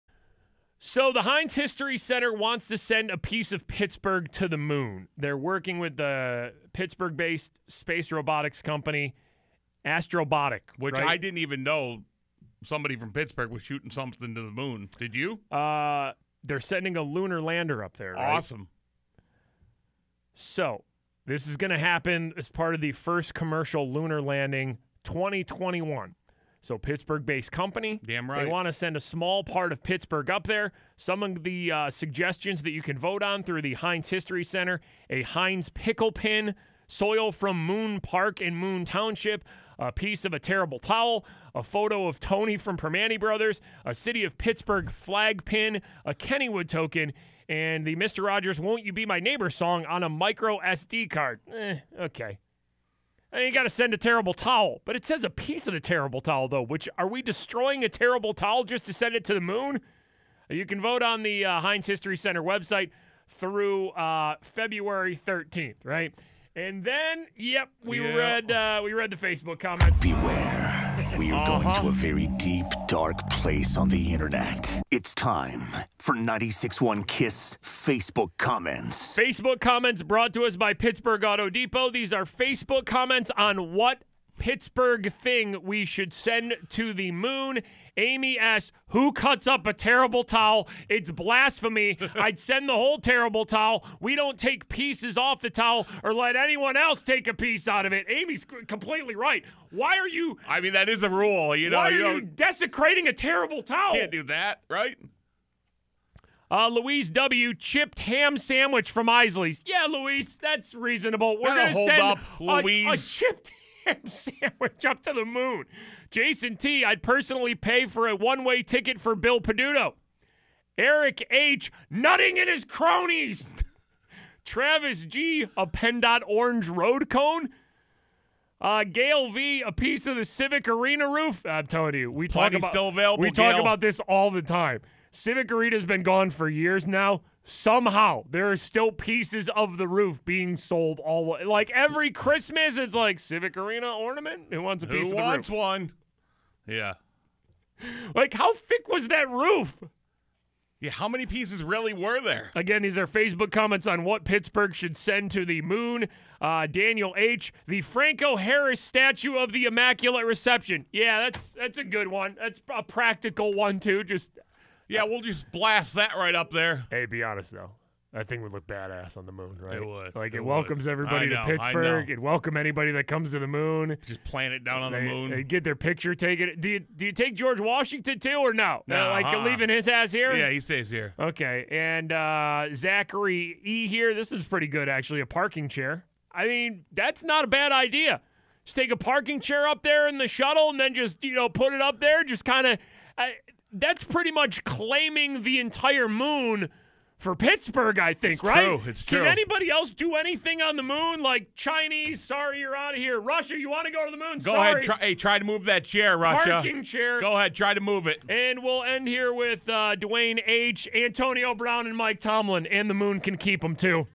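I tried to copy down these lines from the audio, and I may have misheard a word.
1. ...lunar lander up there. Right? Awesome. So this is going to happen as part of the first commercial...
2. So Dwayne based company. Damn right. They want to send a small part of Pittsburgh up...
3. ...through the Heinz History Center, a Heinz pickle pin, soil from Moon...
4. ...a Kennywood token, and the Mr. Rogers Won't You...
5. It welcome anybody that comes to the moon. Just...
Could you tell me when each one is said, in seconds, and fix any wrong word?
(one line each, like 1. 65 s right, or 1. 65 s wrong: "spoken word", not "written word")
1. 17 s right
2. 26 s wrong: "Pittsburgh", not "Dwayne"
3. 33 s right
4. 46 s right
5. 172 s right.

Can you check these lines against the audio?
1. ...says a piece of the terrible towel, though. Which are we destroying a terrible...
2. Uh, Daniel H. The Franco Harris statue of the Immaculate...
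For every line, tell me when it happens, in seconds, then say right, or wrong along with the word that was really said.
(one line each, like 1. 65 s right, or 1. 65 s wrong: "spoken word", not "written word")
1. 55 s right
2. 156 s right.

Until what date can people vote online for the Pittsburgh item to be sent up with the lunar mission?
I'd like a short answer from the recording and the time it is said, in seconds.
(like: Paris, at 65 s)
February 13th, at 64 s.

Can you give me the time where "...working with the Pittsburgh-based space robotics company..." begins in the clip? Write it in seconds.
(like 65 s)
5 s.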